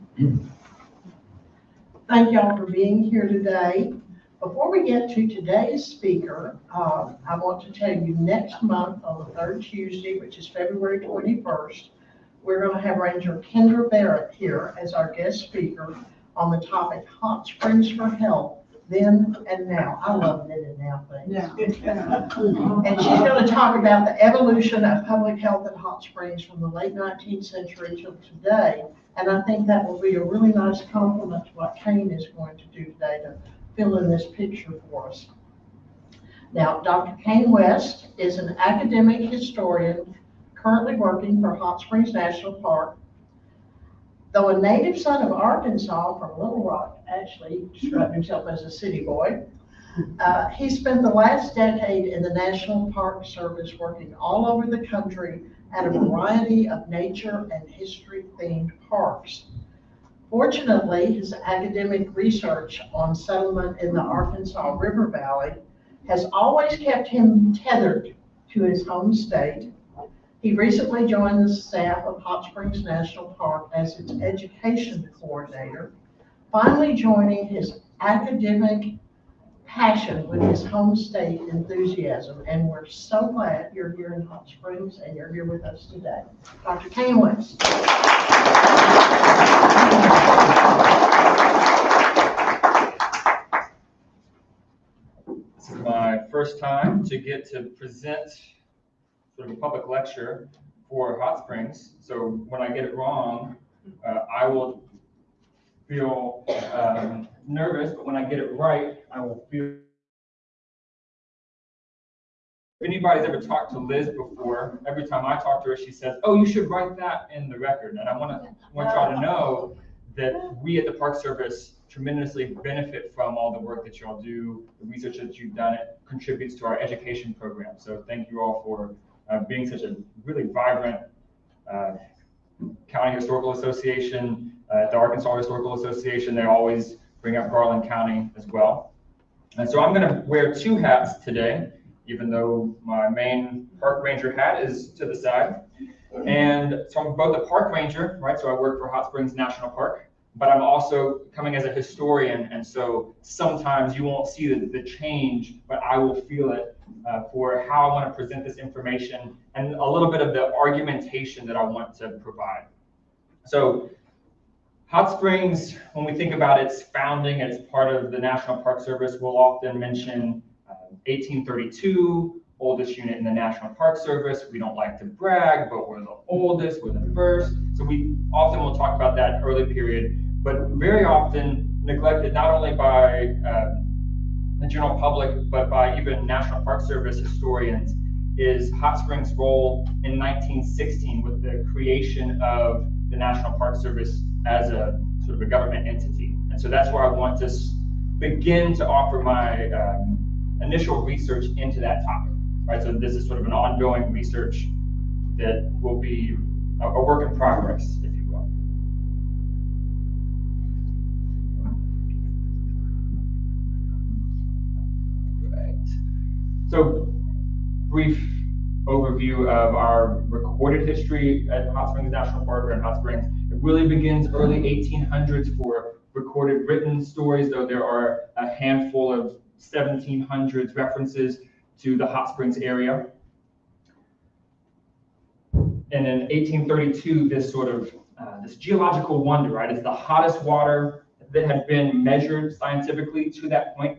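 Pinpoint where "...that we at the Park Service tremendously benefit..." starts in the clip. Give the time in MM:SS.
02:00.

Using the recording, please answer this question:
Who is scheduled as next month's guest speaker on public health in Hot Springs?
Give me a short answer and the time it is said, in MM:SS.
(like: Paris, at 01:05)
Kendra Barrett, at 00:13.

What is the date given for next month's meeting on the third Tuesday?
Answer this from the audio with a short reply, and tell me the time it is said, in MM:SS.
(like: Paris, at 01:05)
February 21st, at 00:10.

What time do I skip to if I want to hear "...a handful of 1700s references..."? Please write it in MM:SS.
03:48.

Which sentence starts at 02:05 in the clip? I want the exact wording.
It contributes to our education program.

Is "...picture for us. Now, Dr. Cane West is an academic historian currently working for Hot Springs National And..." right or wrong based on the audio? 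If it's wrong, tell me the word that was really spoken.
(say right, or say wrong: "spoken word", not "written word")
wrong: "Park", not "And".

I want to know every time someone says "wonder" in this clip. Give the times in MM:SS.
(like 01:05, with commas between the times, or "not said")
03:59.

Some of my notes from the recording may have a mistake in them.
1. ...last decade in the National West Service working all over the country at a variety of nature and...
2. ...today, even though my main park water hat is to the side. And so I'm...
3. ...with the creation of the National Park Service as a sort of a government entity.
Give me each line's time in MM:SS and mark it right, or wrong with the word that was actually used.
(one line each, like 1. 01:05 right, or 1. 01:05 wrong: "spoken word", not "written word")
1. 00:51 wrong: "Park", not "West"
2. 02:21 wrong: "ranger", not "water"
3. 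03:11 right.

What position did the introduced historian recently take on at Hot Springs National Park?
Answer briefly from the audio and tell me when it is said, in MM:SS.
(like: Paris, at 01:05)
education coordinator, at 01:14.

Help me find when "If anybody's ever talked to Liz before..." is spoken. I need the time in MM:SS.
01:52.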